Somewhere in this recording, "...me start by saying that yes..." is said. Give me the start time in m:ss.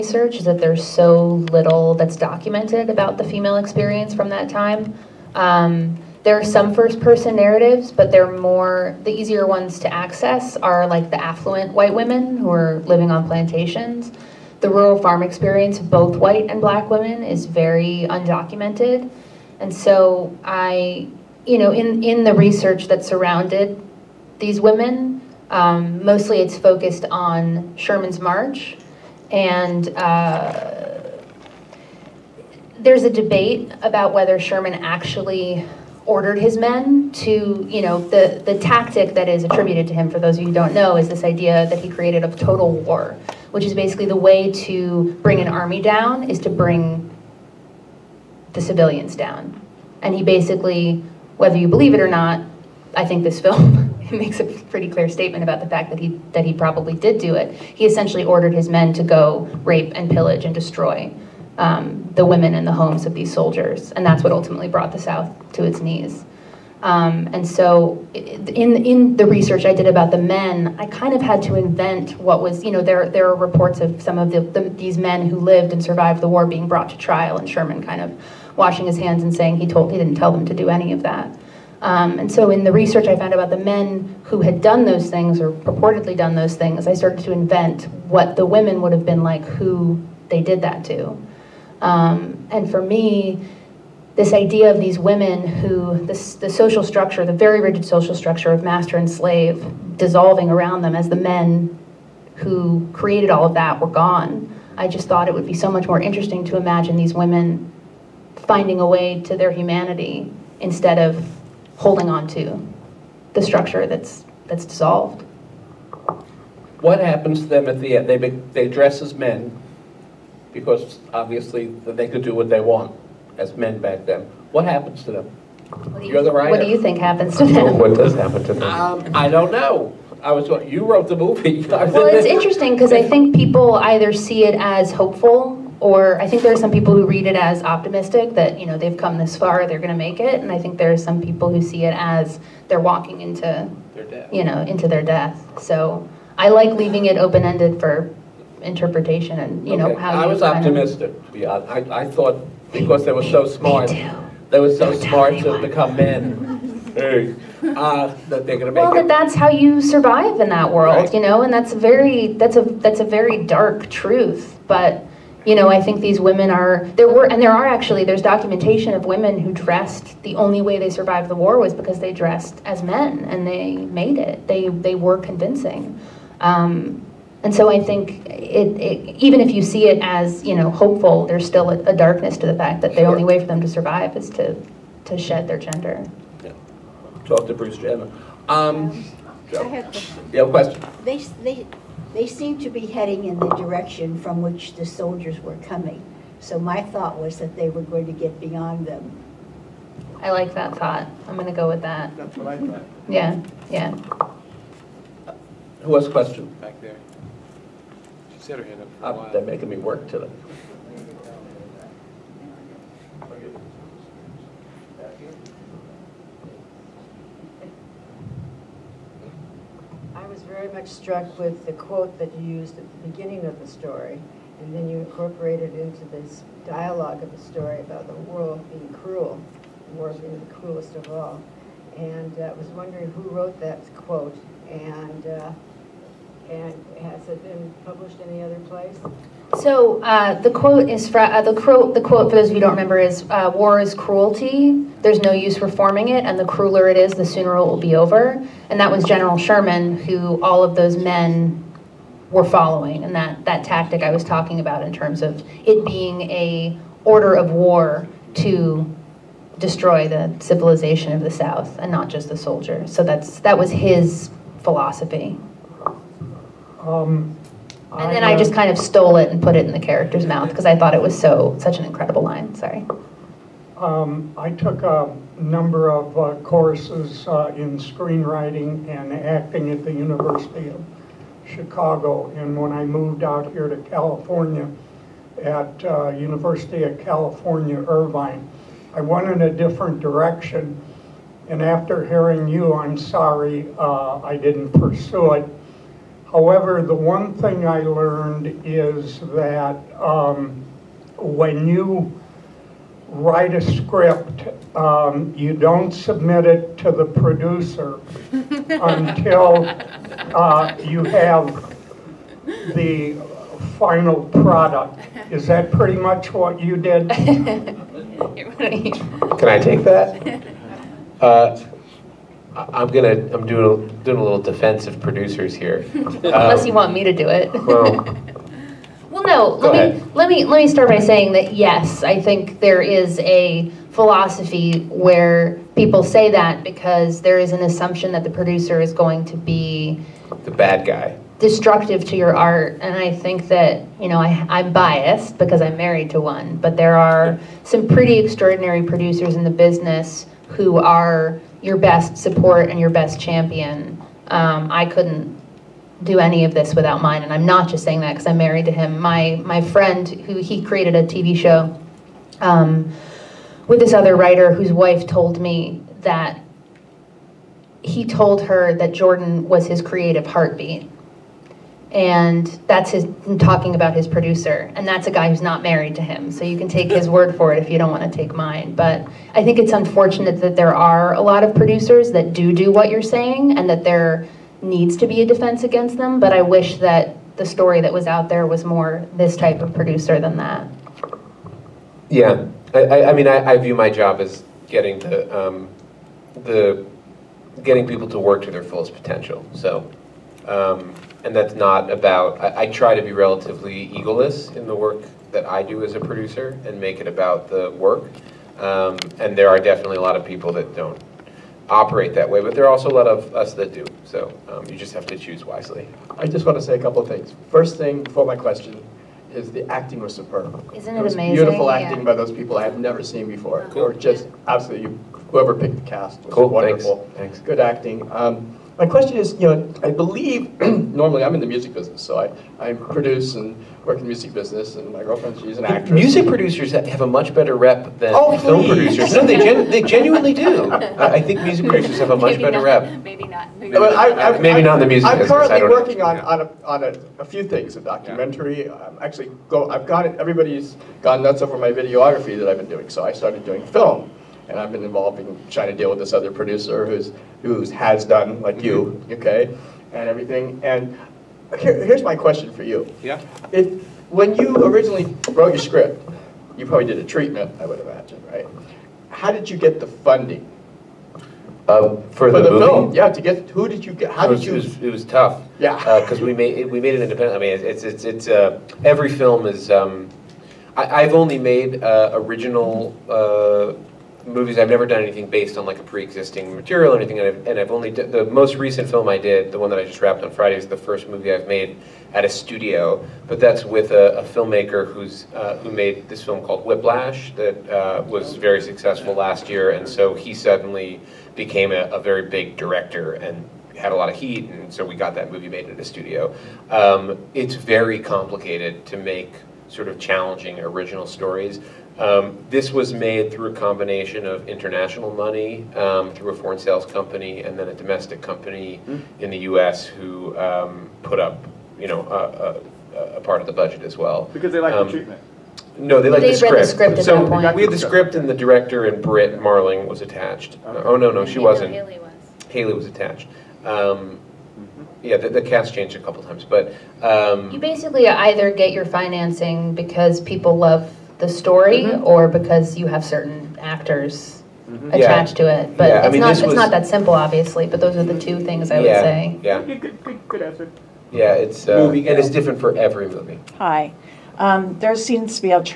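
5:30.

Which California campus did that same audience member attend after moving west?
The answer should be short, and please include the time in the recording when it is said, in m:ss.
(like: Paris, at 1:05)
University of California, Irvine, at 4:46.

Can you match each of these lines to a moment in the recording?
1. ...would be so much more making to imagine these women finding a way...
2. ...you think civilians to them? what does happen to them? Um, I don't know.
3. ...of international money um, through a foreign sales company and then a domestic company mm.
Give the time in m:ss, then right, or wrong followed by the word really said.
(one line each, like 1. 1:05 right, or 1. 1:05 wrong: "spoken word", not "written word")
1. 1:45 wrong: "interesting", not "making"
2. 2:06 wrong: "happens", not "civilians"
3. 8:34 right.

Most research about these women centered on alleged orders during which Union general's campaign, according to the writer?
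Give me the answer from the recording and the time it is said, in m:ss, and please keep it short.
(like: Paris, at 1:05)
Sherman's March, at 0:27.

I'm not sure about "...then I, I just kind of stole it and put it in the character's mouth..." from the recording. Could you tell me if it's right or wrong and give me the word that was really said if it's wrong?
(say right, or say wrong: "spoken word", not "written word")
right.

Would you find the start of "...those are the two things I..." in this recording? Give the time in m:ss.
9:07.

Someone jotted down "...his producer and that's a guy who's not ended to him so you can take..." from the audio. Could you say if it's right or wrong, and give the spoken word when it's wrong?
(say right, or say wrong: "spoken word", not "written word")
wrong: "married", not "ended".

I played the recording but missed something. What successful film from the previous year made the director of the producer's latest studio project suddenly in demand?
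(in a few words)
Whiplash.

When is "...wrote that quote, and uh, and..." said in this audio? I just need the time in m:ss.
3:53.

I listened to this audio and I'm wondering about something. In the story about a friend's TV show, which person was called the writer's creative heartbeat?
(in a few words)
Jordan.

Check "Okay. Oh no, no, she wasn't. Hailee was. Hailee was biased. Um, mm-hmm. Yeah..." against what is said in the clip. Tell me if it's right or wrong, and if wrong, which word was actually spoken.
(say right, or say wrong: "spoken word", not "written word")
wrong: "attached", not "biased".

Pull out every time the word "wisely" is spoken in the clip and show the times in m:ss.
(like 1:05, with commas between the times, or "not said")
6:55.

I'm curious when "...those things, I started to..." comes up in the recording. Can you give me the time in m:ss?
1:26.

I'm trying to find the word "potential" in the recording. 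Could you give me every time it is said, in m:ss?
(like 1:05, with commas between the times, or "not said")
6:38.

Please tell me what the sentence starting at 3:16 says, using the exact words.
So my thought was that they were going to get beyond them.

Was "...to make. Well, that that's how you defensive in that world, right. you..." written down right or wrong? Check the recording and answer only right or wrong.
wrong.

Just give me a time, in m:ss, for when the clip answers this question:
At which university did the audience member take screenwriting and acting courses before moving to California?
4:39.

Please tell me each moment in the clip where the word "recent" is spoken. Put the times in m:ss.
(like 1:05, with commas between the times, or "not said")
8:08.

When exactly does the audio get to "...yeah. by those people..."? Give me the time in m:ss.
7:01.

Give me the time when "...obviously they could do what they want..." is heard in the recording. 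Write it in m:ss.
2:01.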